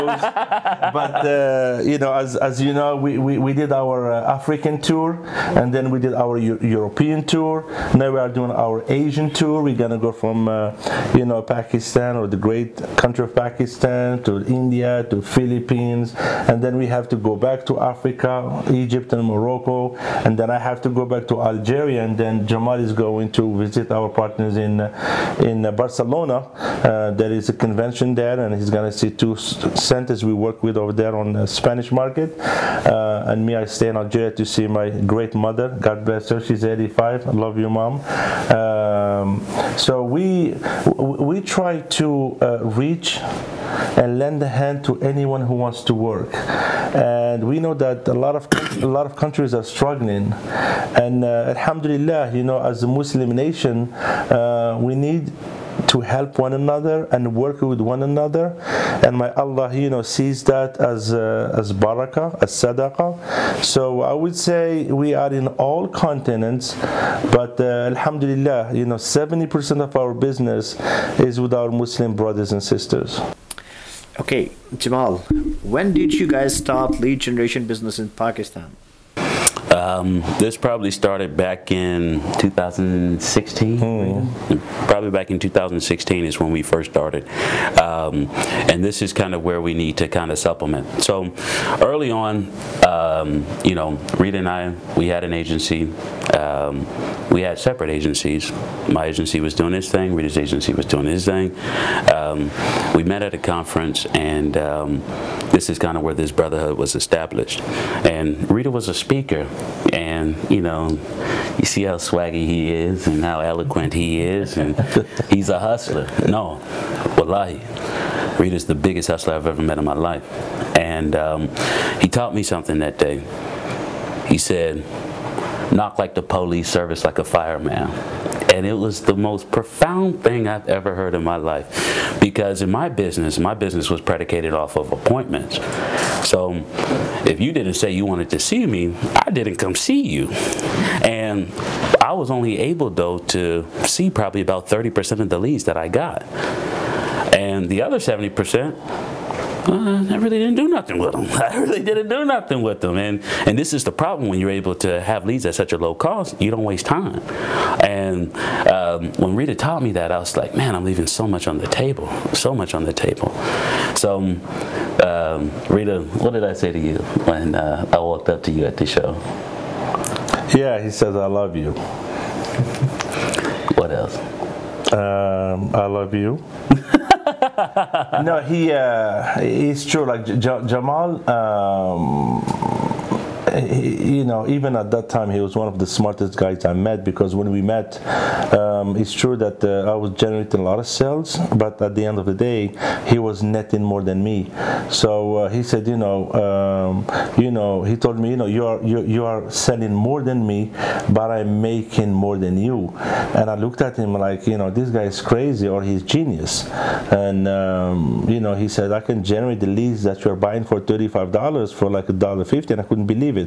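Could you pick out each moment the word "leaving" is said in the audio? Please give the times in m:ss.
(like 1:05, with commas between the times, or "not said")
2:40.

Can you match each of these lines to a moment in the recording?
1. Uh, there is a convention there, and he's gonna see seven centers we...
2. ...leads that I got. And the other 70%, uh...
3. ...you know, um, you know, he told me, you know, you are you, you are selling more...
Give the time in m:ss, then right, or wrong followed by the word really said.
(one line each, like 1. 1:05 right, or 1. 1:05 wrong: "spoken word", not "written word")
1. 0:26 wrong: "two", not "seven"
2. 2:25 right
3. 3:15 right.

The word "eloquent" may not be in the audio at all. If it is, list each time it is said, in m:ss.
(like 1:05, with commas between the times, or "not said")
1:53.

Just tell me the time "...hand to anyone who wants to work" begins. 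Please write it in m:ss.
0:44.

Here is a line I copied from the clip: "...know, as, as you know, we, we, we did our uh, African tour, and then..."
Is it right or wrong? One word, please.
right.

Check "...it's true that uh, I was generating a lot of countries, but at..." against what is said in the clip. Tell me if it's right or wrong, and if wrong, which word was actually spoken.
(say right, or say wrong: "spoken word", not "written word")
wrong: "sales", not "countries".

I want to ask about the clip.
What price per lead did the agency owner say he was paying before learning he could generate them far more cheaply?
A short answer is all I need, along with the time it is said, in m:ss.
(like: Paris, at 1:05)
$35, at 3:30.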